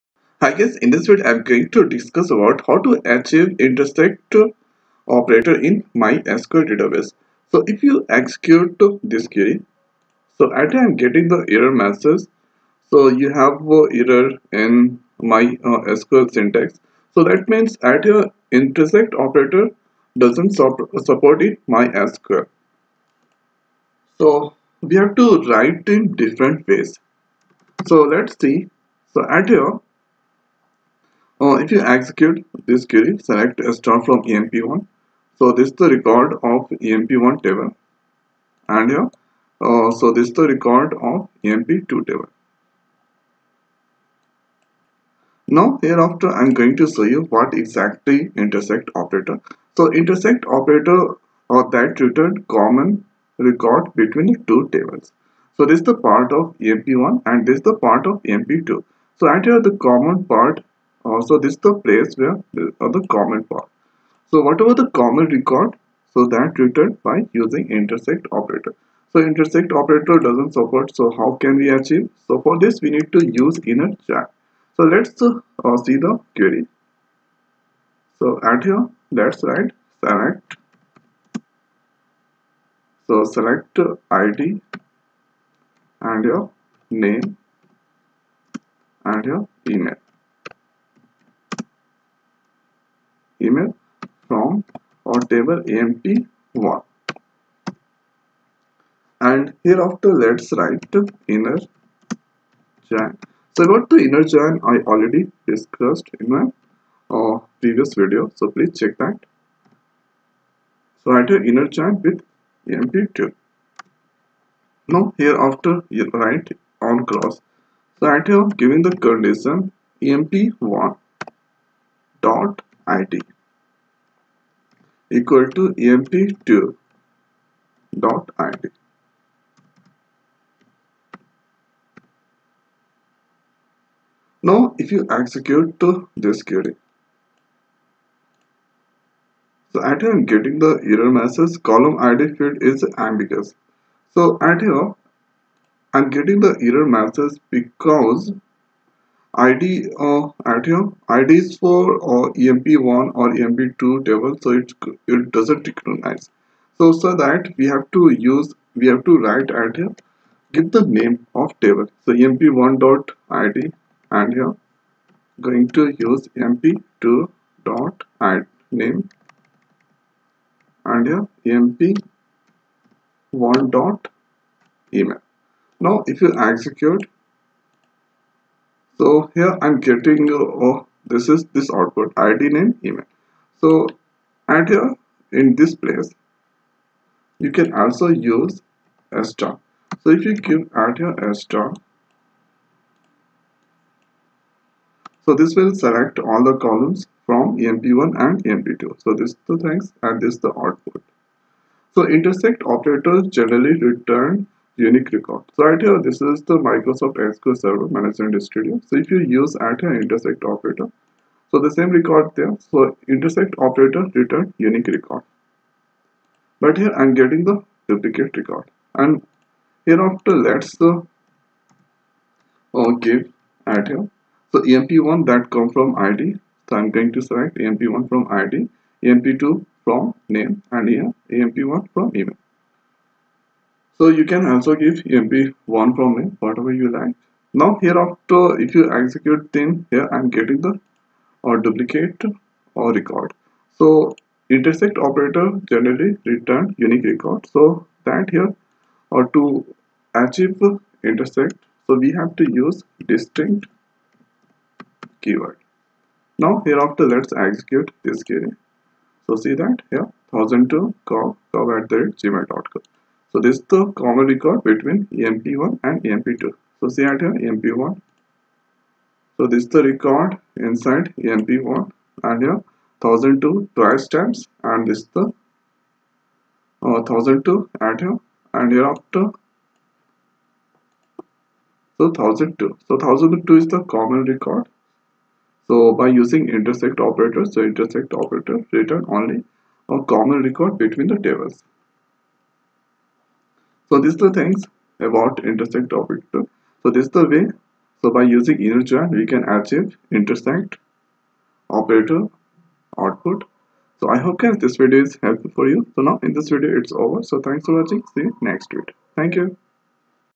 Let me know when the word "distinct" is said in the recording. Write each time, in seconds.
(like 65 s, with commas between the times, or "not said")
253 s.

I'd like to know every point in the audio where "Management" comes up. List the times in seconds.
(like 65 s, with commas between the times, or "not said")
207 s.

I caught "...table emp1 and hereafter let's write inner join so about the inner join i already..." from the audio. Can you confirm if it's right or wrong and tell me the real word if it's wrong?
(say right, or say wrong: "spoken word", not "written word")
right.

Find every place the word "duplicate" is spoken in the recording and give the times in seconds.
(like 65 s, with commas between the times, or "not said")
217 s, 241 s.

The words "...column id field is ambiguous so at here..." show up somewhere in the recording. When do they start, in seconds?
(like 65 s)
141 s.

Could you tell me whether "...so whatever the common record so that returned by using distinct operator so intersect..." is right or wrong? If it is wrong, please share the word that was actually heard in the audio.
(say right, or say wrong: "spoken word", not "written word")
wrong: "intersect", not "distinct".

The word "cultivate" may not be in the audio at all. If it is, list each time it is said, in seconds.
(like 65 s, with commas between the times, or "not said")
not said.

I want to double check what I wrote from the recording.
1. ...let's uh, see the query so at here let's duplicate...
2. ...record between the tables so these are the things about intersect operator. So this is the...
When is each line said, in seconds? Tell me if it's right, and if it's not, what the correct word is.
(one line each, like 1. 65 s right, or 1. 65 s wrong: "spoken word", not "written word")
1. 74 s wrong: "write", not "duplicate"
2. 290 s right.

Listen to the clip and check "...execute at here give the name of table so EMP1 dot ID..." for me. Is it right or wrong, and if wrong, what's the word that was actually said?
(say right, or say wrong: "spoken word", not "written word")
wrong: "write", not "execute".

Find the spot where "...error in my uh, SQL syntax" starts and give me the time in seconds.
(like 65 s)
13 s.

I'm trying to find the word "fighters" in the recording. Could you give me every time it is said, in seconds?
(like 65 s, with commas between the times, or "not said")
not said.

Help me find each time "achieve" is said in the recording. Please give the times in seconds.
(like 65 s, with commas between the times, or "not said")
3 s, 71 s, 250 s, 299 s.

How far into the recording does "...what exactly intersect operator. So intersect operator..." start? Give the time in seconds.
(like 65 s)
47 s.